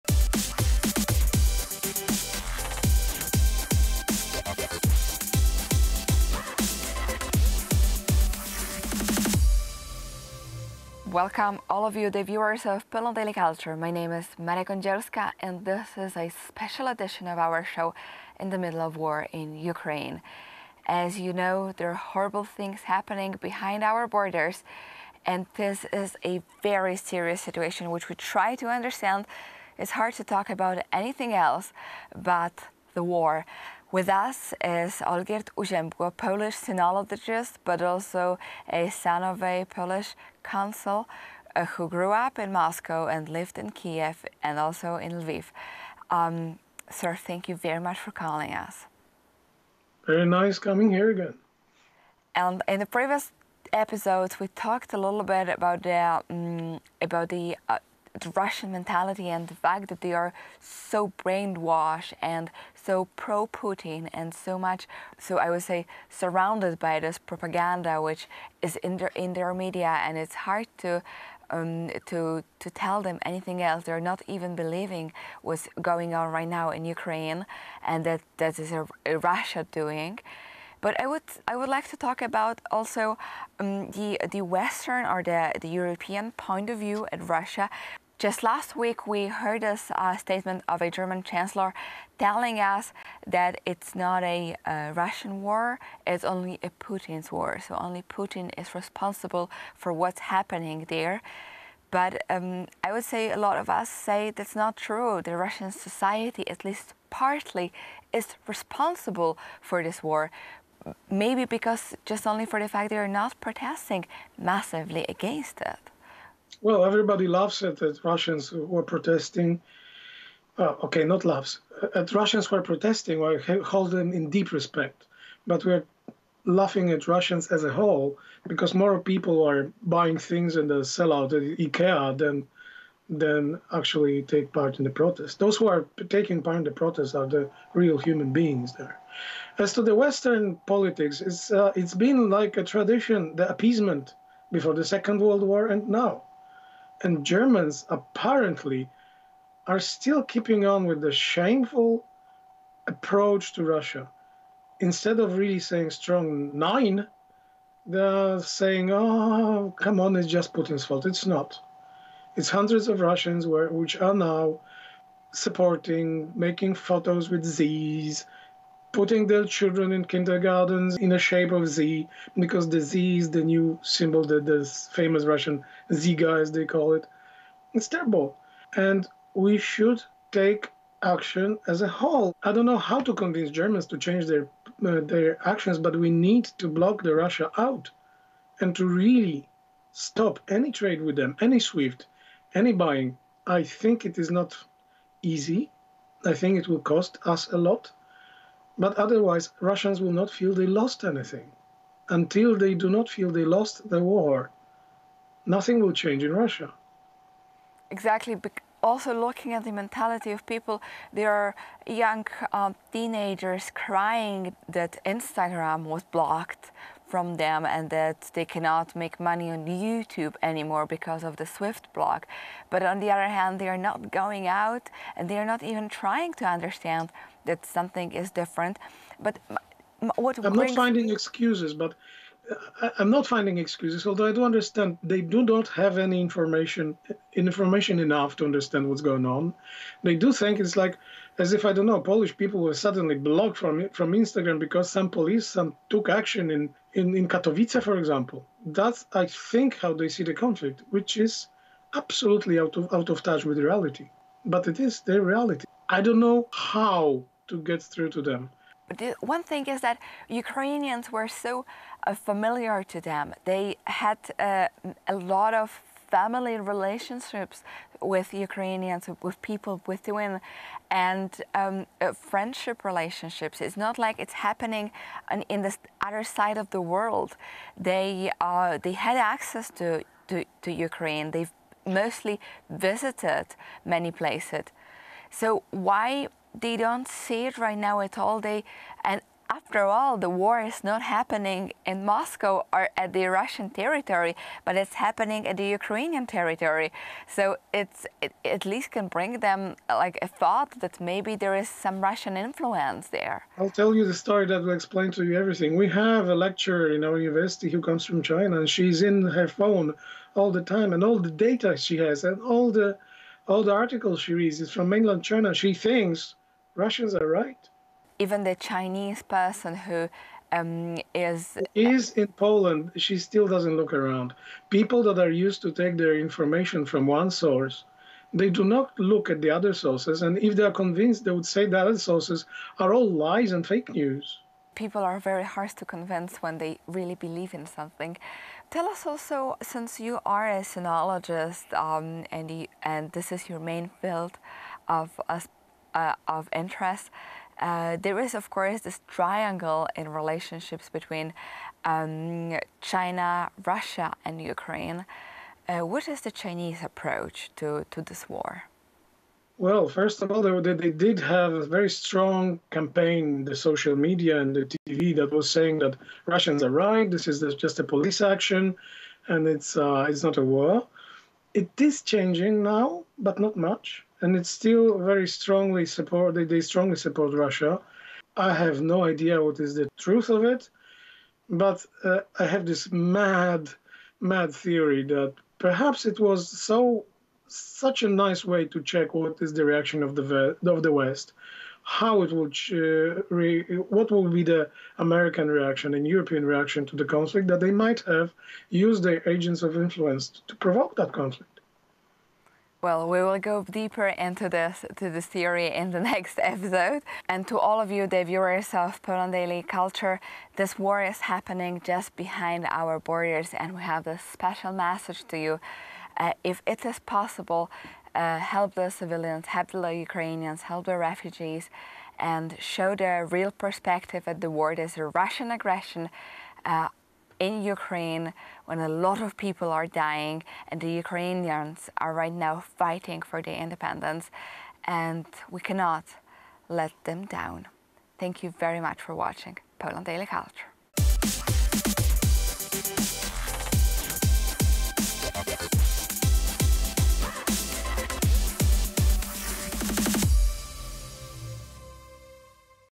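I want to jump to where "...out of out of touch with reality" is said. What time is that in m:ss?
4:12.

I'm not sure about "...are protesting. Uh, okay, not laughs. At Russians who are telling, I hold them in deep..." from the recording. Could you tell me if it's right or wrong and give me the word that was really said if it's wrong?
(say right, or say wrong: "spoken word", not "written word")
wrong: "protesting", not "telling".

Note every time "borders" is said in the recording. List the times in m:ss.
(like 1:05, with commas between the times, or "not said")
0:24, 6:52.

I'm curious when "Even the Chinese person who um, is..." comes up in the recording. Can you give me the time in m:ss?
5:18.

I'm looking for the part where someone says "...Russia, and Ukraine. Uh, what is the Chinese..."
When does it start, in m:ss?
5:53.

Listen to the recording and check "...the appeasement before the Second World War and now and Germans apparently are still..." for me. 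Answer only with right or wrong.
right.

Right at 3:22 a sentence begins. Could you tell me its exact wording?
Until they do not feel they lost the war, nothing will change in Russia.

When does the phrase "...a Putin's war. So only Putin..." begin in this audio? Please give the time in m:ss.
1:36.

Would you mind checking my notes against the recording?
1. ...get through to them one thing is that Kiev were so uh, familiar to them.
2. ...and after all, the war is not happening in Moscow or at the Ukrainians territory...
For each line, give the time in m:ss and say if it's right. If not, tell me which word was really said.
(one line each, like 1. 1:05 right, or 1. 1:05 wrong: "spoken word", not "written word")
1. 4:17 wrong: "Ukrainians", not "Kiev"
2. 4:49 wrong: "Russian", not "Ukrainians".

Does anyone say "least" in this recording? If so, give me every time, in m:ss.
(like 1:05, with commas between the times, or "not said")
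1:46, 4:58.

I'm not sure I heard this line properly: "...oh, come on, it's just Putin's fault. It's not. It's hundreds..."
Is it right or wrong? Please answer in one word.
right.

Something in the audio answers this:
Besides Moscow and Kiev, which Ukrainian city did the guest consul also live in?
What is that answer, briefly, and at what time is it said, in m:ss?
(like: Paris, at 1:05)
Lviv, at 0:45.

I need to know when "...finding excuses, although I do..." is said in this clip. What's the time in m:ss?
3:53.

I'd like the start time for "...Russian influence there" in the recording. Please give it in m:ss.
5:02.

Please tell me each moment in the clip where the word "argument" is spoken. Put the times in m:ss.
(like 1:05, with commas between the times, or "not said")
not said.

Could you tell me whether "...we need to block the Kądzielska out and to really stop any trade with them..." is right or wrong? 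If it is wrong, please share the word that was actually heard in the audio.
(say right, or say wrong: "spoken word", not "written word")
wrong: "Russia", not "Kądzielska".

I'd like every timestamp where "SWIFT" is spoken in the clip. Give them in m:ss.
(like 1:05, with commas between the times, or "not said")
3:11, 3:41.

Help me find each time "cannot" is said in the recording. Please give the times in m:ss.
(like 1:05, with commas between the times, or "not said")
3:38, 7:15.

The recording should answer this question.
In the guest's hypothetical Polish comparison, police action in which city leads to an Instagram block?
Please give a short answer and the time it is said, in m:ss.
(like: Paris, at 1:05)
Katowice, at 4:07.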